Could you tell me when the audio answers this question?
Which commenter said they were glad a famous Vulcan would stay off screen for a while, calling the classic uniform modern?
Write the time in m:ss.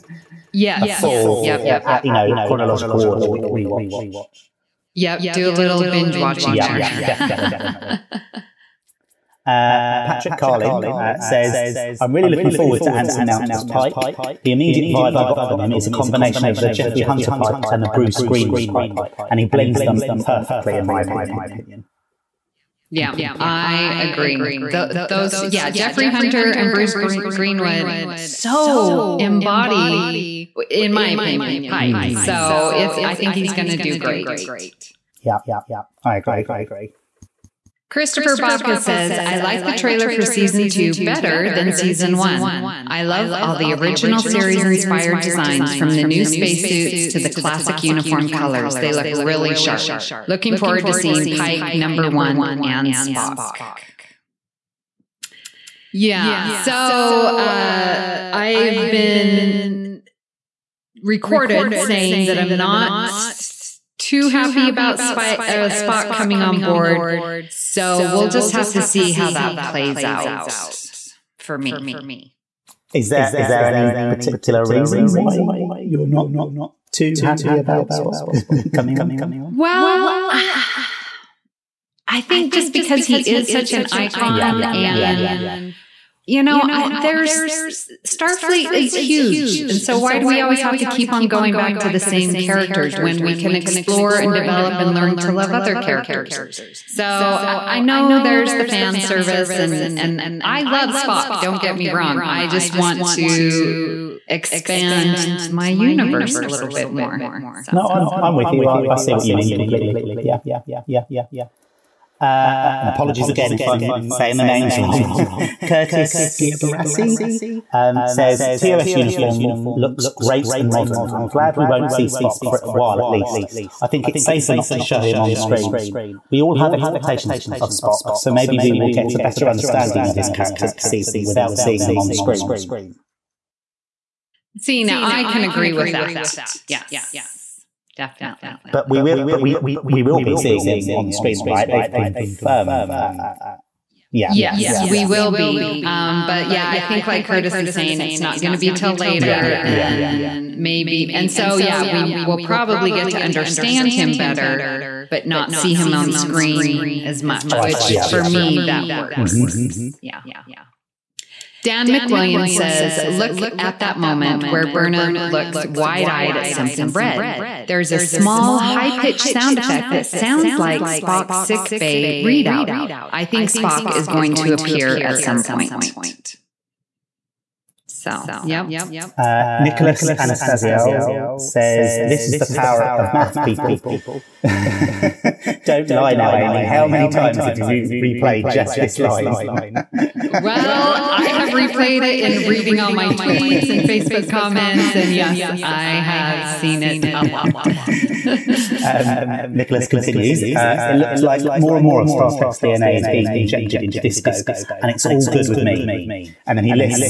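1:55.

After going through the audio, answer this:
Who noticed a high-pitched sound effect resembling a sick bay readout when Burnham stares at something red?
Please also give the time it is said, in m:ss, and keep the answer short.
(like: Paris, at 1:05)
Dan McWilliams, at 2:41.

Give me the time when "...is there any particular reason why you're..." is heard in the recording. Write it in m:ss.
1:13.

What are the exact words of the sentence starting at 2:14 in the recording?
See, now I can agree with that.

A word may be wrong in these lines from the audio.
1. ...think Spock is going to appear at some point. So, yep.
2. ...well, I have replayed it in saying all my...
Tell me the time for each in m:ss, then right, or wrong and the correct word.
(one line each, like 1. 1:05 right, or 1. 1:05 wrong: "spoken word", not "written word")
1. 2:53 right
2. 3:10 wrong: "reading", not "saying".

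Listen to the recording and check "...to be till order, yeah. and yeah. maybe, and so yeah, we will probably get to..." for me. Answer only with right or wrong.
wrong.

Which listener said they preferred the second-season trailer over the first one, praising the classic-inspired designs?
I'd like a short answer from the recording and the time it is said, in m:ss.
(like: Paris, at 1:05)
Christopher Baca, at 0:37.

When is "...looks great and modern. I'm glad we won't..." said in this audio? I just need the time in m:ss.
1:59.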